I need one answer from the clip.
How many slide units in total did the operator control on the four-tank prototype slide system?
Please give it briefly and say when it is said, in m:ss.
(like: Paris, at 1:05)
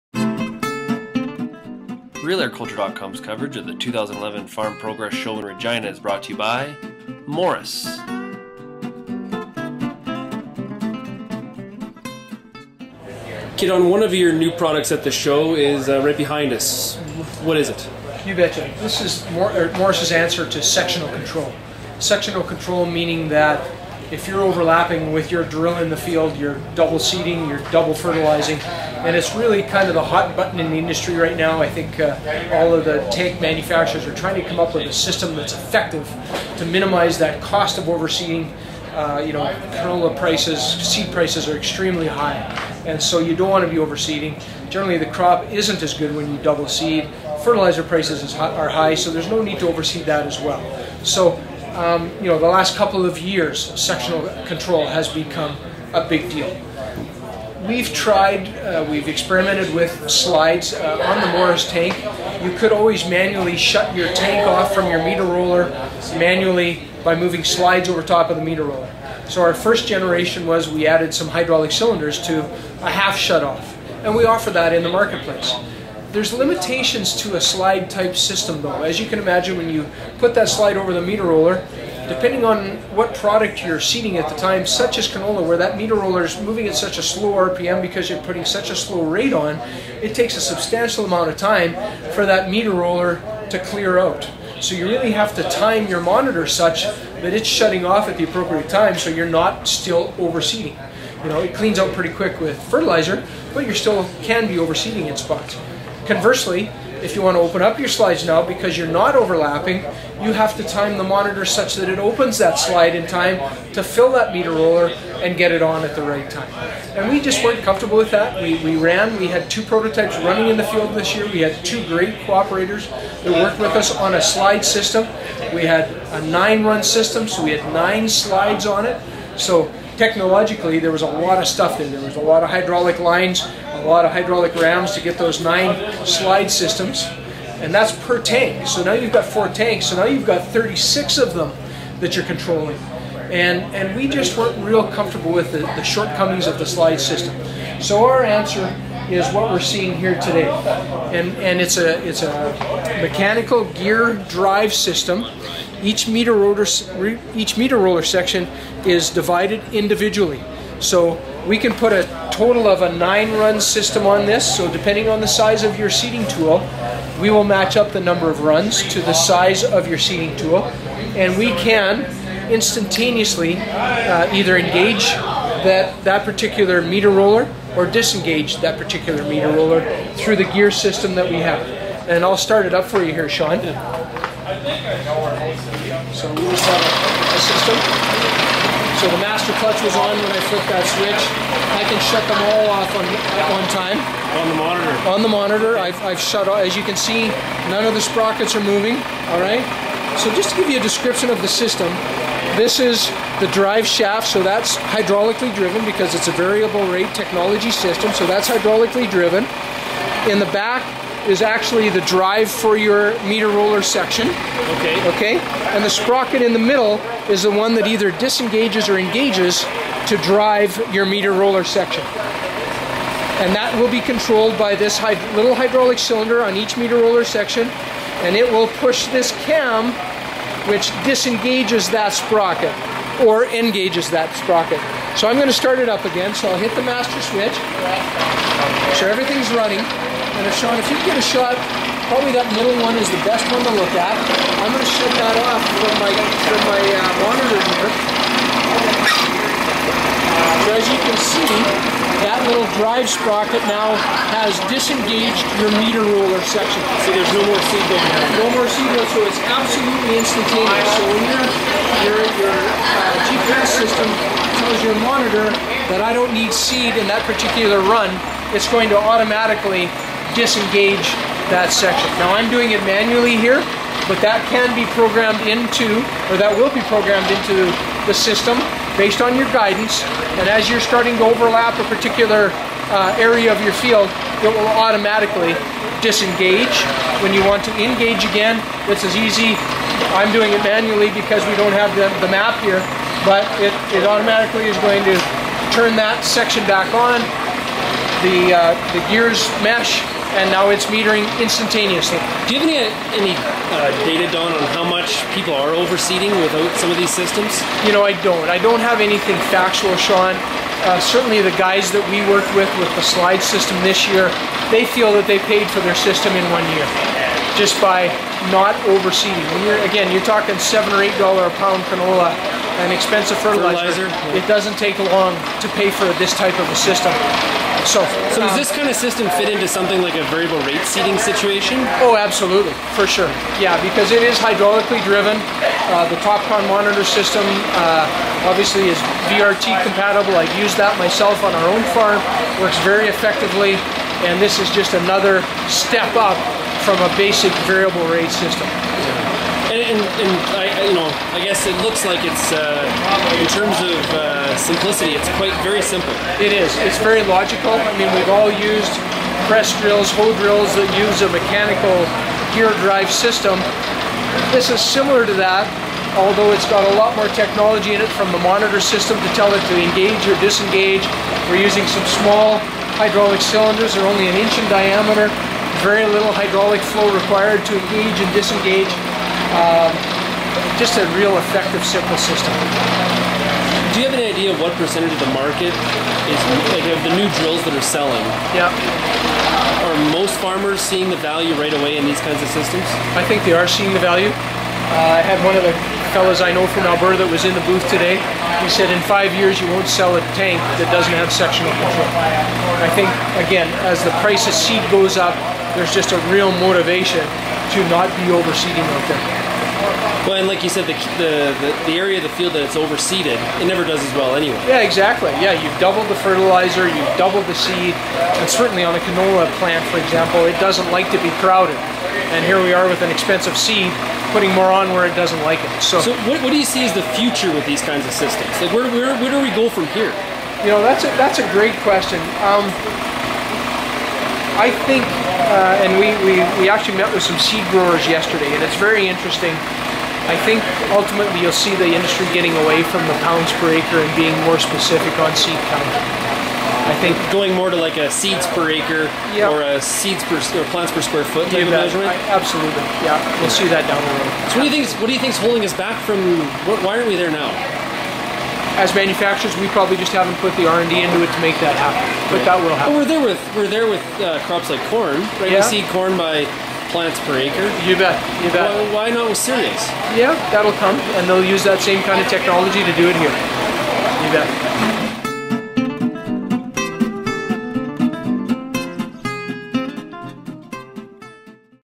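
36, at 2:20.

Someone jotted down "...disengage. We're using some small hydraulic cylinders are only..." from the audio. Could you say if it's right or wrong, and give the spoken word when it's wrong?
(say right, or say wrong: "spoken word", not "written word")
right.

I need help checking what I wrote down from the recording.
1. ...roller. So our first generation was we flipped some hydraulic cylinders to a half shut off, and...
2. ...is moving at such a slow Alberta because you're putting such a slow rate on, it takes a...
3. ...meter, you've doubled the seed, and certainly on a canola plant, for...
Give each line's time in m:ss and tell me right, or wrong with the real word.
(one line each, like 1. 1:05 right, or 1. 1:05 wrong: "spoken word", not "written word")
1. 1:08 wrong: "added", not "flipped"
2. 1:26 wrong: "RPM", not "Alberta"
3. 6:56 wrong: "fertilizer", not "meter".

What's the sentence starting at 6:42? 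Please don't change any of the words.
I think, again, as the price of seed goes up, there's just a real motivation to not be overseeding out there.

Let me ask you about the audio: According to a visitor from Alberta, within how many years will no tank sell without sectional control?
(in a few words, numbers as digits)
5 years.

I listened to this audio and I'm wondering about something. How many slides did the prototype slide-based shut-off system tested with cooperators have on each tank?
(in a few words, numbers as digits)
9.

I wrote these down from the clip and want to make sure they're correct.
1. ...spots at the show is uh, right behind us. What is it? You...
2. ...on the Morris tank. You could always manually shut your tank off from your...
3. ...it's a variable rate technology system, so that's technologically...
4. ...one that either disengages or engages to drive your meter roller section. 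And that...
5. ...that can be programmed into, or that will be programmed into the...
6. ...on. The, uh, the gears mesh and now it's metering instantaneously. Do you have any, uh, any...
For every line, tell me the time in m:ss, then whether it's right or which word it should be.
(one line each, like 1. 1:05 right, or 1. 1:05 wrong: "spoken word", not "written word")
1. 0:14 wrong: "products", not "spots"
2. 1:01 right
3. 3:26 wrong: "hydraulically", not "technologically"
4. 3:37 right
5. 4:34 right
6. 4:56 right.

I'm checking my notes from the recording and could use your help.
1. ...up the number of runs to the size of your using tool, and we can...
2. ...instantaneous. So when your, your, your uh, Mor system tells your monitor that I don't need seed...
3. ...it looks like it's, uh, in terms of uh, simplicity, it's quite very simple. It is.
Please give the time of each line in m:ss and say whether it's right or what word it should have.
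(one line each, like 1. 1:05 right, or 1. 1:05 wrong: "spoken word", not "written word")
1. 2:47 wrong: "seeding", not "using"
2. 4:20 wrong: "GPS", not "Mor"
3. 5:51 right.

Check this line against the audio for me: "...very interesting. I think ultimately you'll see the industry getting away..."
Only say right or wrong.
right.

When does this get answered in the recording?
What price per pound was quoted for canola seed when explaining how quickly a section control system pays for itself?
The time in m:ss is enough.
5:20.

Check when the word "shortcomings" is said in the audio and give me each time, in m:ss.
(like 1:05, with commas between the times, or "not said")
2:25.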